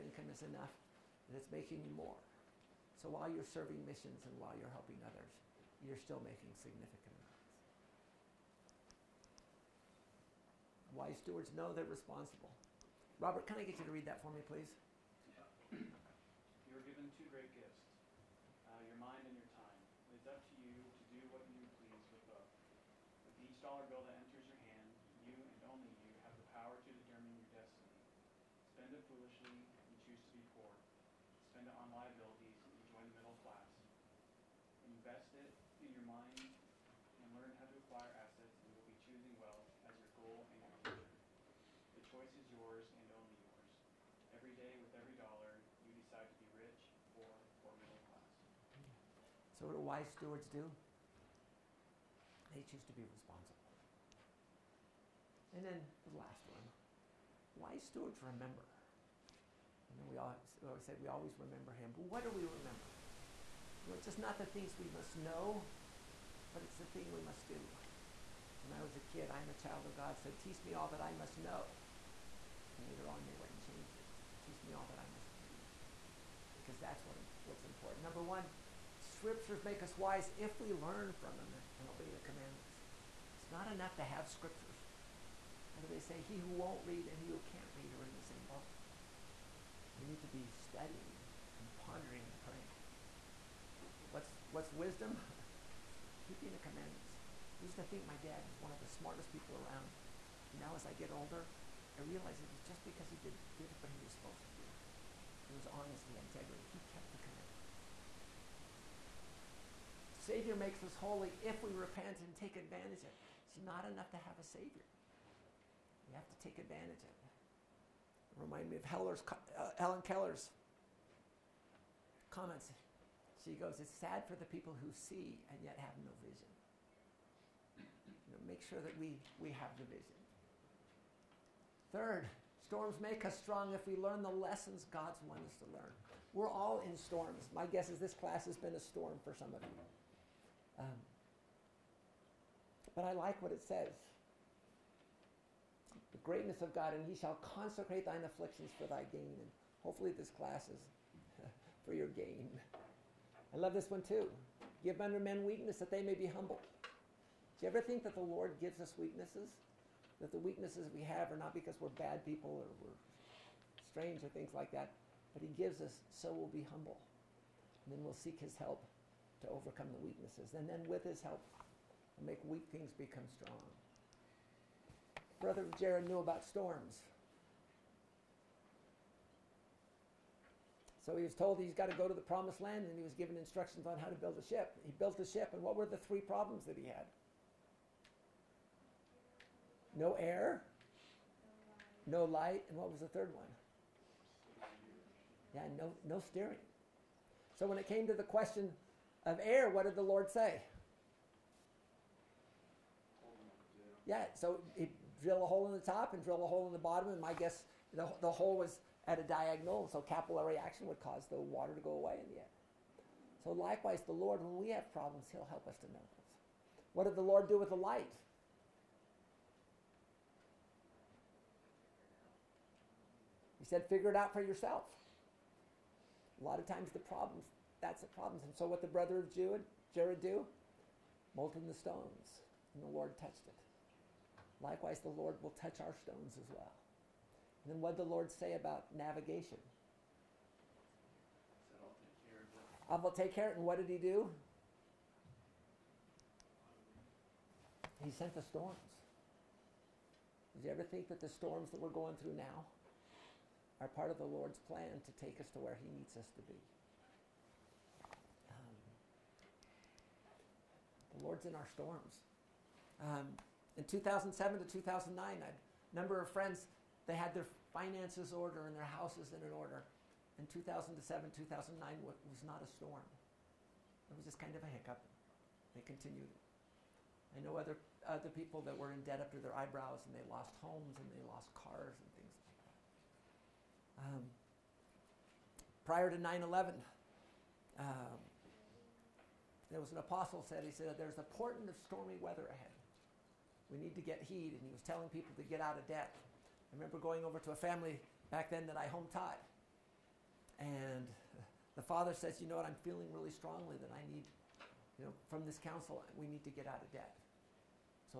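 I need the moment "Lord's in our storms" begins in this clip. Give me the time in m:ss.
4:21.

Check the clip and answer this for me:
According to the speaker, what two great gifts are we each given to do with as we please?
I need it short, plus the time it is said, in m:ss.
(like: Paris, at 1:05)
your mind and your time, at 0:18.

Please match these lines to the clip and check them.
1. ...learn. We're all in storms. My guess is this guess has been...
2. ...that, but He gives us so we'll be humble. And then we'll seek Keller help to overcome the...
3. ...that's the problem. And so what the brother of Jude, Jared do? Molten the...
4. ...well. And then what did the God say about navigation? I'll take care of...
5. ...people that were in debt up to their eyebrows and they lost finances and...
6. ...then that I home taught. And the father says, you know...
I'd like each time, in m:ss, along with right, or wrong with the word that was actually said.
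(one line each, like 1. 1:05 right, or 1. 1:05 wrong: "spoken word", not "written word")
1. 2:15 wrong: "class", not "guess"
2. 2:44 wrong: "His", not "Keller"
3. 3:47 right
4. 3:56 wrong: "Lord", not "God"
5. 4:38 wrong: "homes", not "finances"
6. 4:58 right.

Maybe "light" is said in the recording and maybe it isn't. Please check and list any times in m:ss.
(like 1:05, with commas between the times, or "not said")
3:12, 3:37.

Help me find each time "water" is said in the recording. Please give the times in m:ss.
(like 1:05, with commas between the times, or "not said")
3:31.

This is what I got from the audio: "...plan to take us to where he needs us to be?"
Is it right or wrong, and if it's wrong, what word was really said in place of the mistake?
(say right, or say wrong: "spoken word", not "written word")
right.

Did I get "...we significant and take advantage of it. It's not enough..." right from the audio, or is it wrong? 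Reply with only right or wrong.
wrong.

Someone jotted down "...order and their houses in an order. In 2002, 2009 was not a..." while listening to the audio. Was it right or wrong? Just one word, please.
wrong.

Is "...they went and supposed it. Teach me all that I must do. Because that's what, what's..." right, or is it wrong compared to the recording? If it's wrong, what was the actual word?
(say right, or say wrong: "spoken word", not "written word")
wrong: "changed", not "supposed".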